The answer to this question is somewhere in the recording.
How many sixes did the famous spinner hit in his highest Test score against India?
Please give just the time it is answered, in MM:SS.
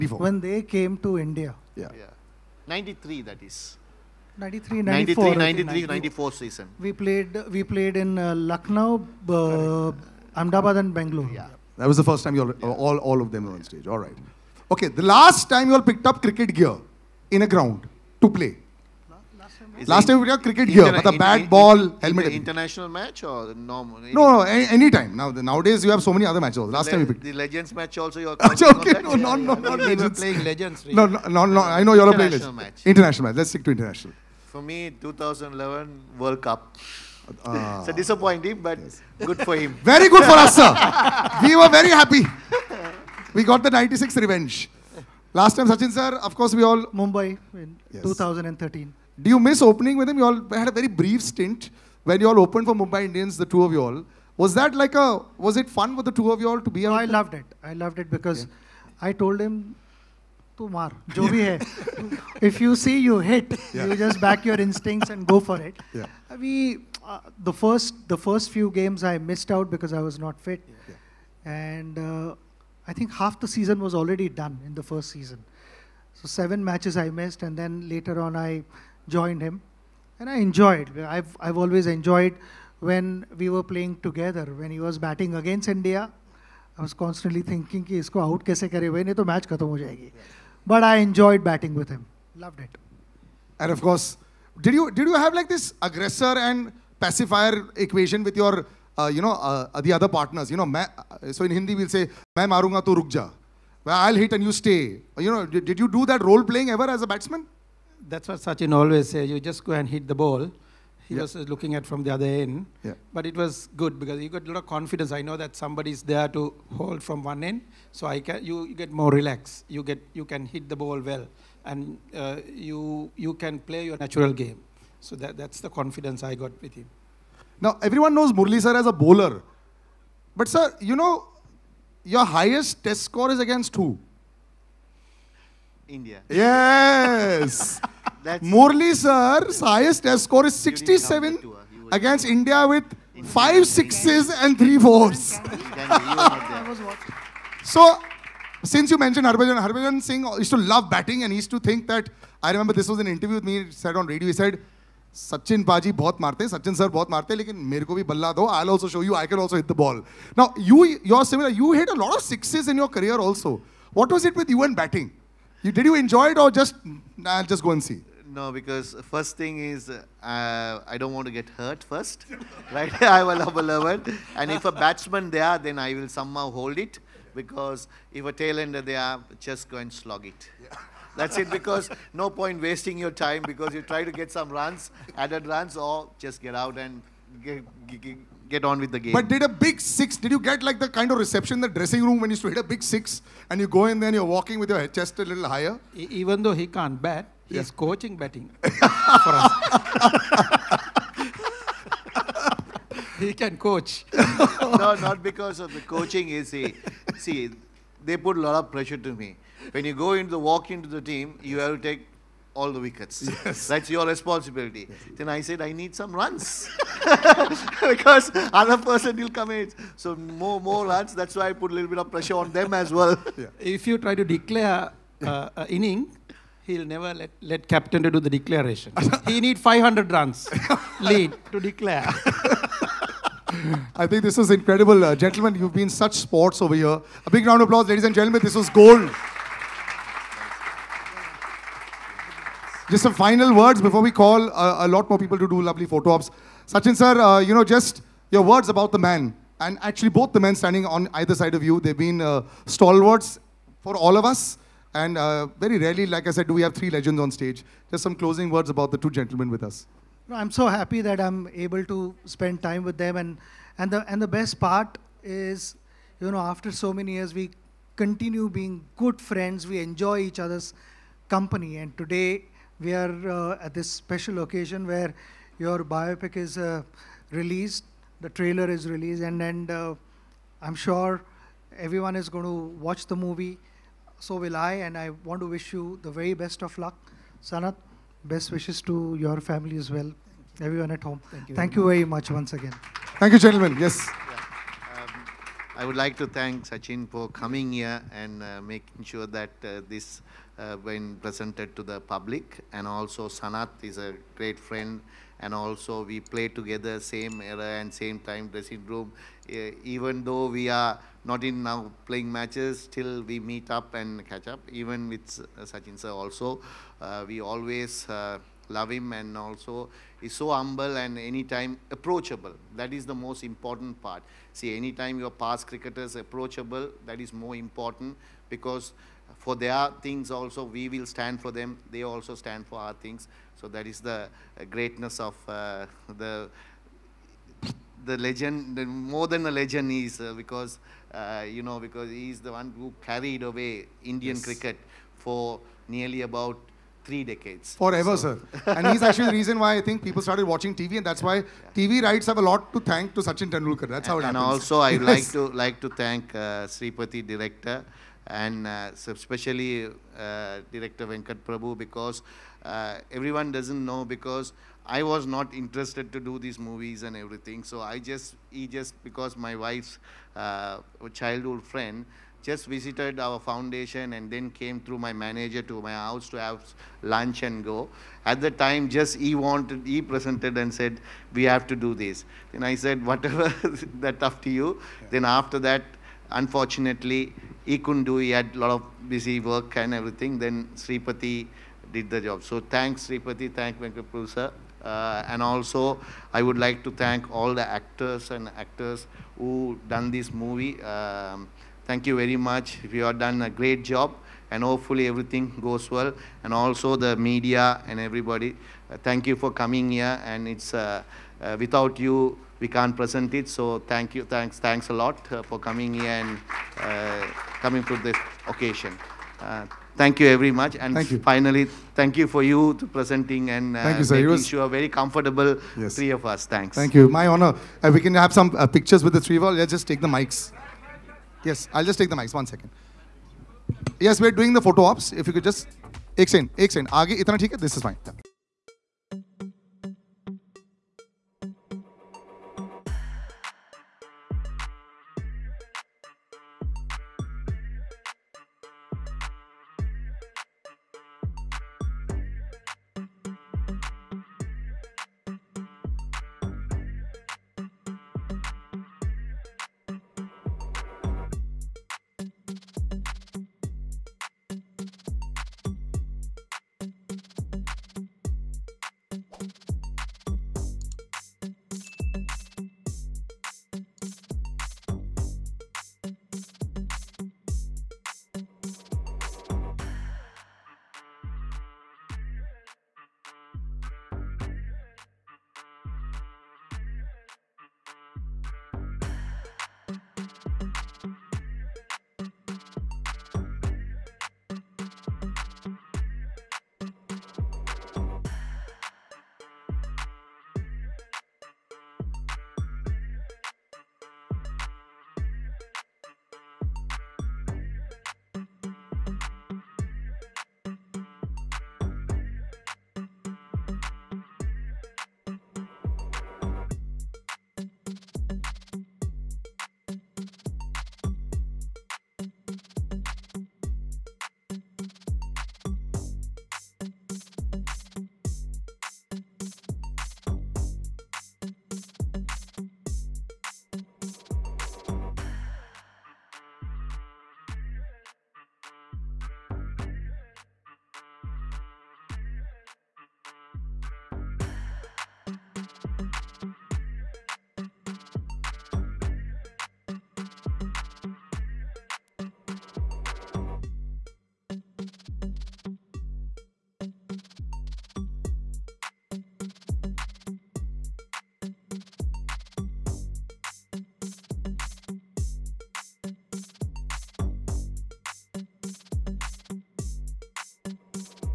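02:23.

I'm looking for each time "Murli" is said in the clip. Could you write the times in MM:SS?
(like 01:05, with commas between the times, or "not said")
02:08, 02:18.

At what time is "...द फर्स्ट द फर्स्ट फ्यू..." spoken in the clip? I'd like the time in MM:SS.
01:06.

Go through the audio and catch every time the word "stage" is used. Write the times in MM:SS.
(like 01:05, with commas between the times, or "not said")
00:13, 04:17.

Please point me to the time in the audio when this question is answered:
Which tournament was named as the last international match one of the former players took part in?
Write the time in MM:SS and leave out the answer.
00:35.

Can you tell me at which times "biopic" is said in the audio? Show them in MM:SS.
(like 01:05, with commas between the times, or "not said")
04:35.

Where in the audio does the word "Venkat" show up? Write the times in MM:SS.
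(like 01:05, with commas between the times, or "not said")
06:01, 06:33.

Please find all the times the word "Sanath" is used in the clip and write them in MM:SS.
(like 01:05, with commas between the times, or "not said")
04:47, 05:03.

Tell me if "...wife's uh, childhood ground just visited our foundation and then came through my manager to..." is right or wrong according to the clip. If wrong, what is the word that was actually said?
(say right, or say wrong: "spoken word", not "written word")
wrong: "friend", not "ground".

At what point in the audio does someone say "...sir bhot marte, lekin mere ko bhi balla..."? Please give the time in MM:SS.
02:36.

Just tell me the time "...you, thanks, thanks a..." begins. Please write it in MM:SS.
06:54.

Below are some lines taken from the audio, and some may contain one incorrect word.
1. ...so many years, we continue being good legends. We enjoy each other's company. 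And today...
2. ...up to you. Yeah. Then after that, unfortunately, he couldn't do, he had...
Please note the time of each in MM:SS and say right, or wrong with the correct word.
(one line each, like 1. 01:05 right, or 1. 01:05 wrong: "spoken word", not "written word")
1. 04:26 wrong: "friends", not "legends"
2. 06:24 right.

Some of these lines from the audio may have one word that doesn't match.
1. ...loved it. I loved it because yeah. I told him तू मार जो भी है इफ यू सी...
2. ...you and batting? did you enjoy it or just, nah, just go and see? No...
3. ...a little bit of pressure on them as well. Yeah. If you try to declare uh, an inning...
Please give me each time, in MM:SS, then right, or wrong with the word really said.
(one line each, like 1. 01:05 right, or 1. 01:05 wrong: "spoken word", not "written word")
1. 00:57 right
2. 02:44 right
3. 03:41 right.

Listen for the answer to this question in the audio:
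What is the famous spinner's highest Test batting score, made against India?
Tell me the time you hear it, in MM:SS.
02:20.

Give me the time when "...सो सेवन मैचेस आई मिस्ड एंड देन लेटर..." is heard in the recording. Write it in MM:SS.
01:16.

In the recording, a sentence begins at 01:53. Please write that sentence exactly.
But it was good because you got a lot of confidence.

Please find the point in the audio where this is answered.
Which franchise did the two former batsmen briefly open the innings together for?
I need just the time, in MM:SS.
00:52.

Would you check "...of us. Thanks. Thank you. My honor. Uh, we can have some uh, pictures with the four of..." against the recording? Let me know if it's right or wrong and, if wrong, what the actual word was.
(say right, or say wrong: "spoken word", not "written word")
wrong: "three", not "four".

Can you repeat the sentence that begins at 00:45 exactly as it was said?
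Last time, Sachin sir, of course, we all...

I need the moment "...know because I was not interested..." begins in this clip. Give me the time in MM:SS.
06:03.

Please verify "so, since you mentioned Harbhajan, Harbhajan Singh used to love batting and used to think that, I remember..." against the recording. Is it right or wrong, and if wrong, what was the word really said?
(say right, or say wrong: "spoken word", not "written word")
right.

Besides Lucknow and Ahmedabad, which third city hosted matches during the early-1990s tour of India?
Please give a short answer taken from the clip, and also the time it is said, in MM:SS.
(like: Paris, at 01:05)
Bangalore, at 00:10.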